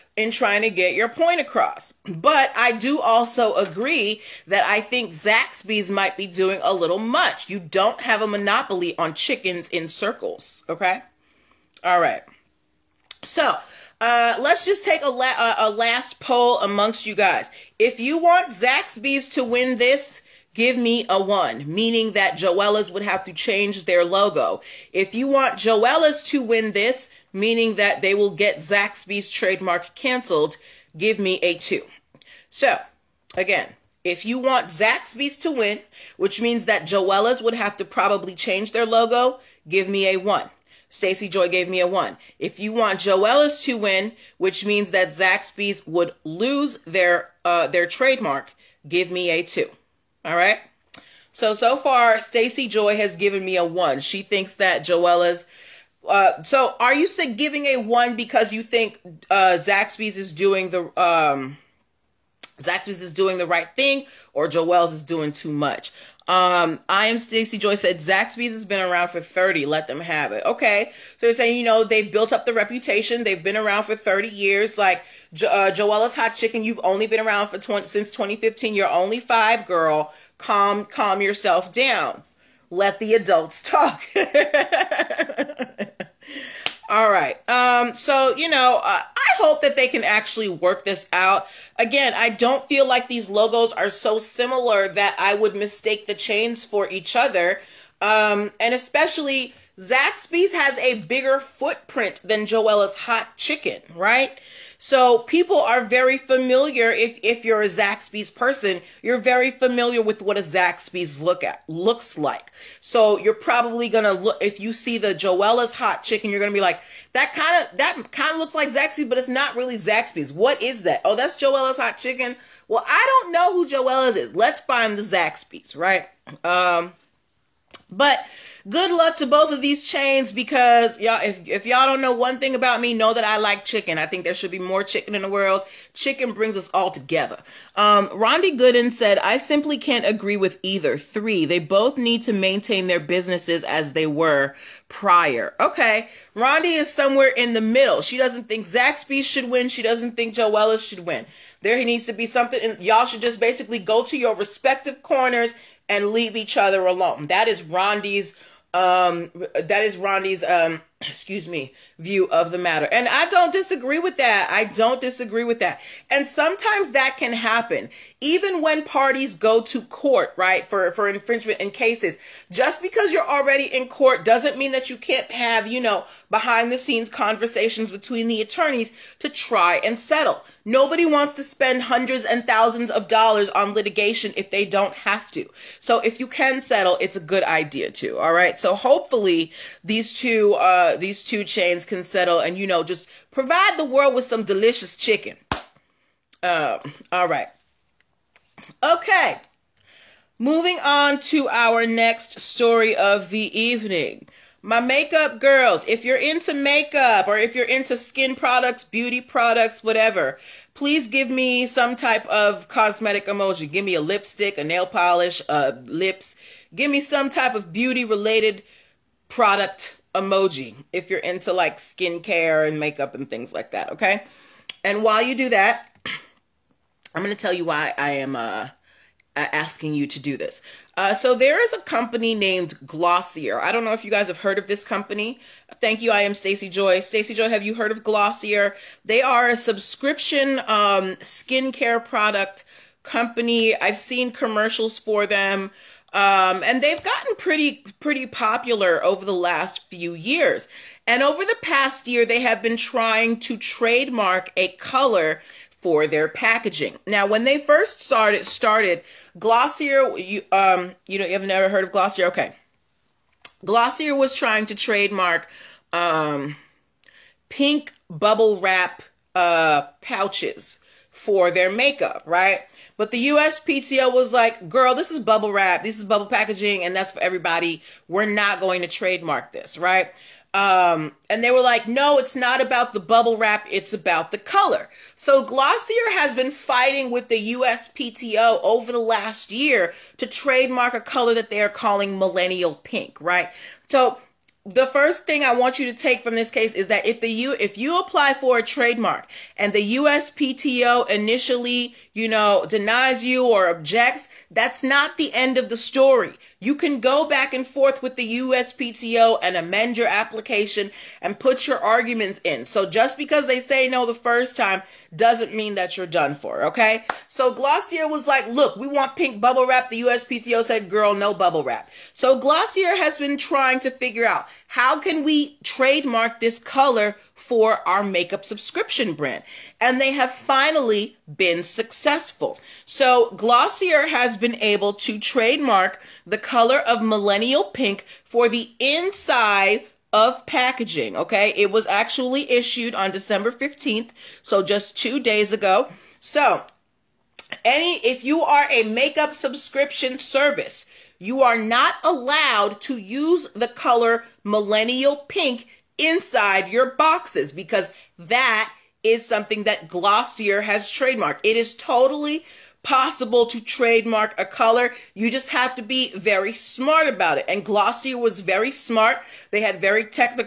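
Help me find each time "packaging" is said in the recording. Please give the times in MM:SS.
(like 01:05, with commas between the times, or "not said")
04:16, 04:36, 05:40.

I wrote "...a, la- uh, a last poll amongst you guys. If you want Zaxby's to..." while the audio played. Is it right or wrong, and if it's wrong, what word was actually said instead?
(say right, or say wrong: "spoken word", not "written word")
right.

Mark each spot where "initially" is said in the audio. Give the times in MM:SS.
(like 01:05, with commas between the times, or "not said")
05:01.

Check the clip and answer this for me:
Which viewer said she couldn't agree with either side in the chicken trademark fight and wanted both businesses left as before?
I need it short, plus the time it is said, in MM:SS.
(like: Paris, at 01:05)
Rondi Gooden, at 02:18.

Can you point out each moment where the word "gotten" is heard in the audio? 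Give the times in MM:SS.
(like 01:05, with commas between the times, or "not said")
04:07.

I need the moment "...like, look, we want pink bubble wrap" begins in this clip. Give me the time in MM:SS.
05:18.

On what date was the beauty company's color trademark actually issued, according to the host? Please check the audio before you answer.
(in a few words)
December 15th.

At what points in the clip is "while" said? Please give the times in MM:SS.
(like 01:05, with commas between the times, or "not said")
03:45.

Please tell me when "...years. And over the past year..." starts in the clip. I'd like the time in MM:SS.
04:10.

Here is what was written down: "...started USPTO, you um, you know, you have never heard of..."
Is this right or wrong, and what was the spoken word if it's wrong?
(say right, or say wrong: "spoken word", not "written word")
wrong: "Glossier", not "USPTO".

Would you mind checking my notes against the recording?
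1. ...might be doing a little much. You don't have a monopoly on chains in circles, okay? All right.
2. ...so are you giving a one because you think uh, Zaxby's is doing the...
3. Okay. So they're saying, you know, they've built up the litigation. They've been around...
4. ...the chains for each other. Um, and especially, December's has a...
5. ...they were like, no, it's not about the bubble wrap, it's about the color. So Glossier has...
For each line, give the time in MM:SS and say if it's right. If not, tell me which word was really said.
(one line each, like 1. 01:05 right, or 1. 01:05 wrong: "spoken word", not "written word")
1. 00:05 wrong: "chickens", not "chains"
2. 00:56 right
3. 01:10 wrong: "reputation", not "litigation"
4. 01:36 wrong: "Zaxby", not "December"
5. 04:41 right.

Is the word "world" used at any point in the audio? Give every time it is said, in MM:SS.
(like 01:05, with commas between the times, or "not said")
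02:15, 03:13.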